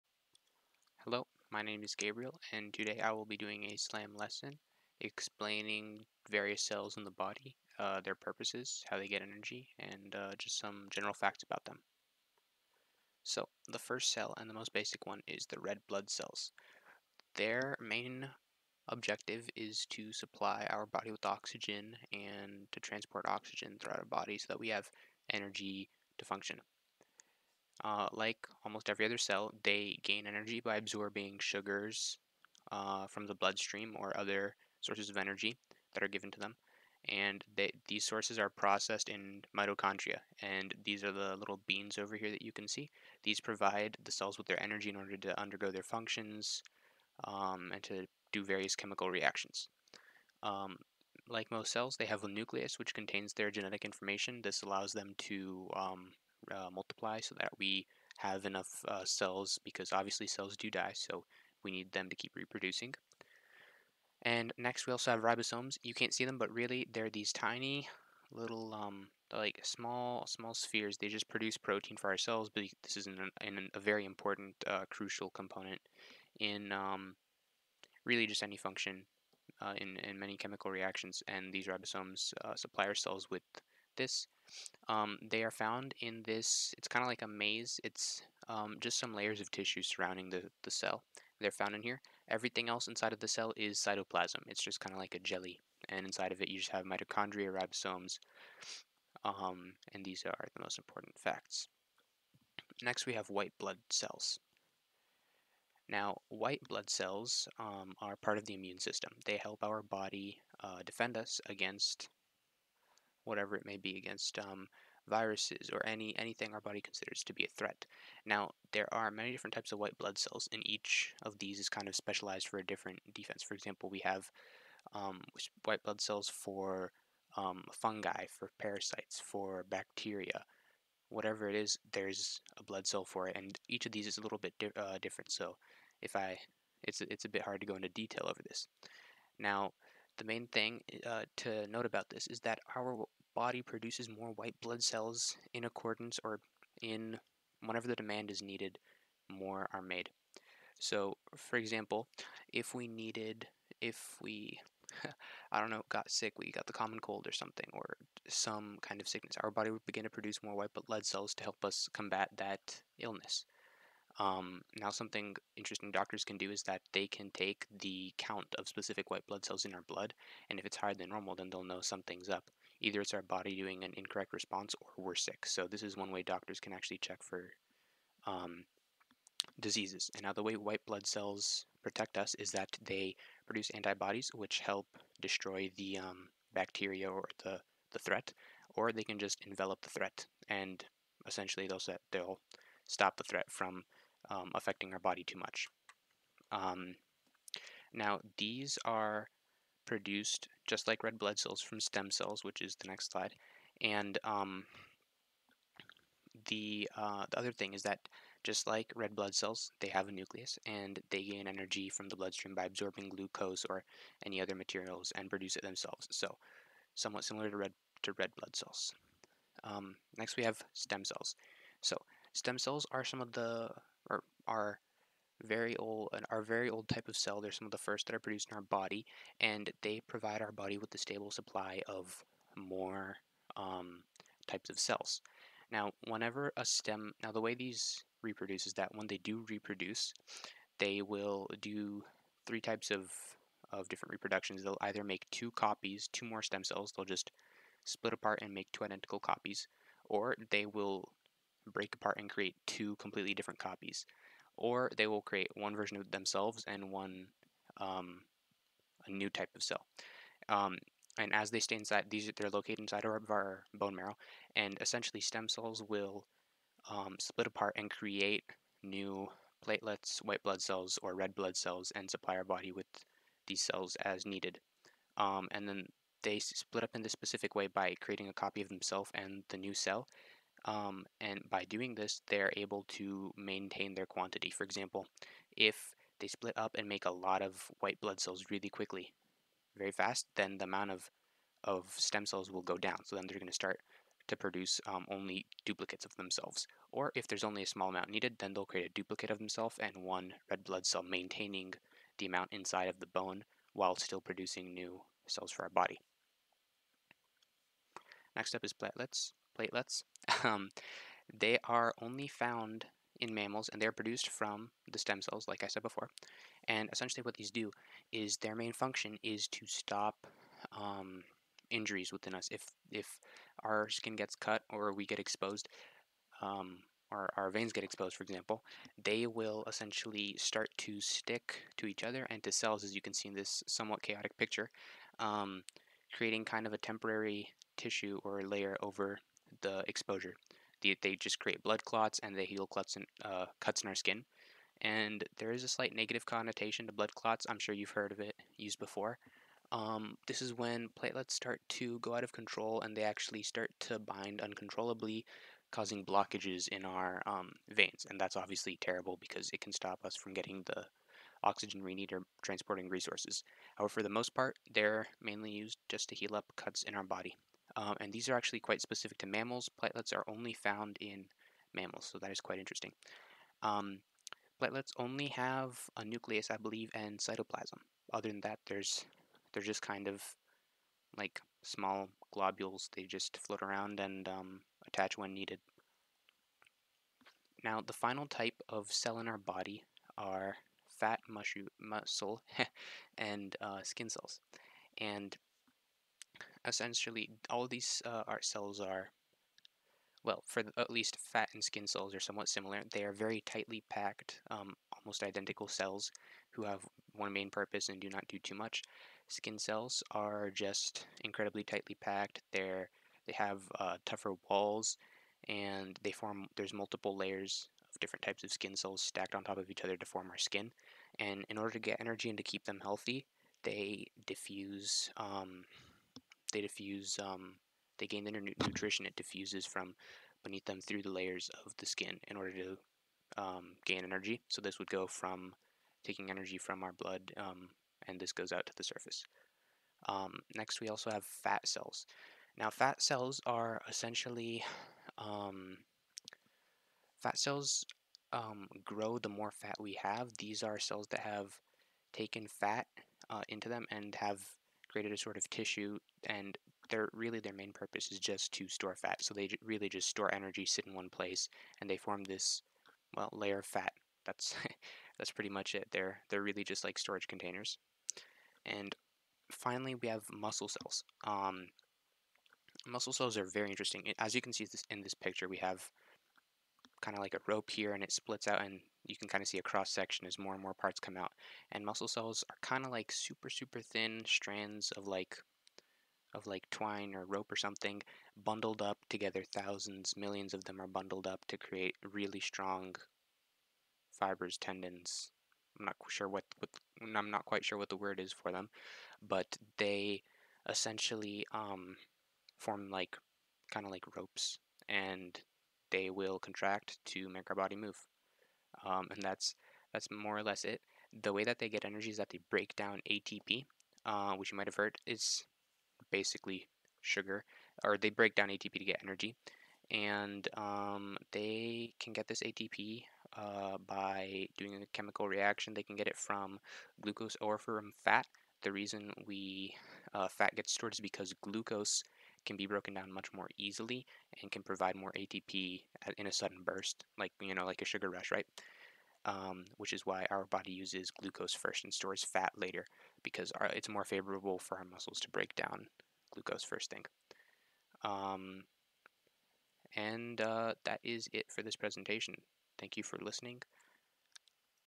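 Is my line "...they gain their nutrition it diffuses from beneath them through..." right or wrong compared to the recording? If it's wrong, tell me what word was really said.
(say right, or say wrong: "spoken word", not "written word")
right.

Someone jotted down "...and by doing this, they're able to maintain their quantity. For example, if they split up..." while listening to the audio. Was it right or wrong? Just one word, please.
right.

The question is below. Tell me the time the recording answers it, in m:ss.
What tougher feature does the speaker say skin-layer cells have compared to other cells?
6:54.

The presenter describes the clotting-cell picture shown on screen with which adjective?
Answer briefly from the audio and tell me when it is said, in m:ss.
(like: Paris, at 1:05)
chaotic, at 5:34.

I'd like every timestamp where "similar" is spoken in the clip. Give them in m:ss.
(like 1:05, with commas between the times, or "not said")
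3:37, 6:42.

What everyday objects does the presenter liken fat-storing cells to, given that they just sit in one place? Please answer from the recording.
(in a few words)
storage containers.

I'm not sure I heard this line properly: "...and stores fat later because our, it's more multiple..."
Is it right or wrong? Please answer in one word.
wrong.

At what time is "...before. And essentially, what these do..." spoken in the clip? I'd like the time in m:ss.
5:15.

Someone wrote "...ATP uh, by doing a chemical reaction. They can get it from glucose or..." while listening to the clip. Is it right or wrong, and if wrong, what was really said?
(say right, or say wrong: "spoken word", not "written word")
right.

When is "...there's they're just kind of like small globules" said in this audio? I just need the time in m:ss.
6:18.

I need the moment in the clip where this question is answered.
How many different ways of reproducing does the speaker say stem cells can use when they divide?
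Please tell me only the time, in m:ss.
4:02.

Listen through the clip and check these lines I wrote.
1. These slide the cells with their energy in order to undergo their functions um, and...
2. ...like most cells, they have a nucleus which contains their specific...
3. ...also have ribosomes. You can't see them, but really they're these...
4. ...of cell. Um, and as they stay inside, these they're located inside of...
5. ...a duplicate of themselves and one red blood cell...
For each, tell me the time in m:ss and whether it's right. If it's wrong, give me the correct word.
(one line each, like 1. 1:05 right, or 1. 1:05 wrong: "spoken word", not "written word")
1. 0:43 wrong: "provide", not "slide"
2. 0:51 wrong: "genetic", not "specific"
3. 1:04 right
4. 4:19 right
5. 4:58 right.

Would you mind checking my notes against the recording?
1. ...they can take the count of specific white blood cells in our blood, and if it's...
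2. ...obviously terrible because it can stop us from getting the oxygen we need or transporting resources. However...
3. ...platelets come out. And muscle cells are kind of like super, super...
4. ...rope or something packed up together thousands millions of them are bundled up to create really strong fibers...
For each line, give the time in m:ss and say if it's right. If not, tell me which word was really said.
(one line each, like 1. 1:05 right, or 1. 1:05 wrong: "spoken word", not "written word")
1. 2:46 right
2. 5:58 right
3. 8:00 wrong: "parts", not "platelets"
4. 8:07 wrong: "bundled", not "packed".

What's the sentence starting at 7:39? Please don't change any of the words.
So they really just store energy, sit in one place, and they form this well layer of fat.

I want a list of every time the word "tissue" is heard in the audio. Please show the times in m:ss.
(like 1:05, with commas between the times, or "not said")
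1:29, 5:37, 7:35.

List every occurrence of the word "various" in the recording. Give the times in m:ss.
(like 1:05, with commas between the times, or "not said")
0:06, 0:48.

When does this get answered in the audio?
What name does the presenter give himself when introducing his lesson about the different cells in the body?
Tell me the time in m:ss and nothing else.
0:01.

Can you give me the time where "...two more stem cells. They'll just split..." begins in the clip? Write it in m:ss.
4:06.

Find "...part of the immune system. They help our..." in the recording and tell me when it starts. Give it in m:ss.
1:48.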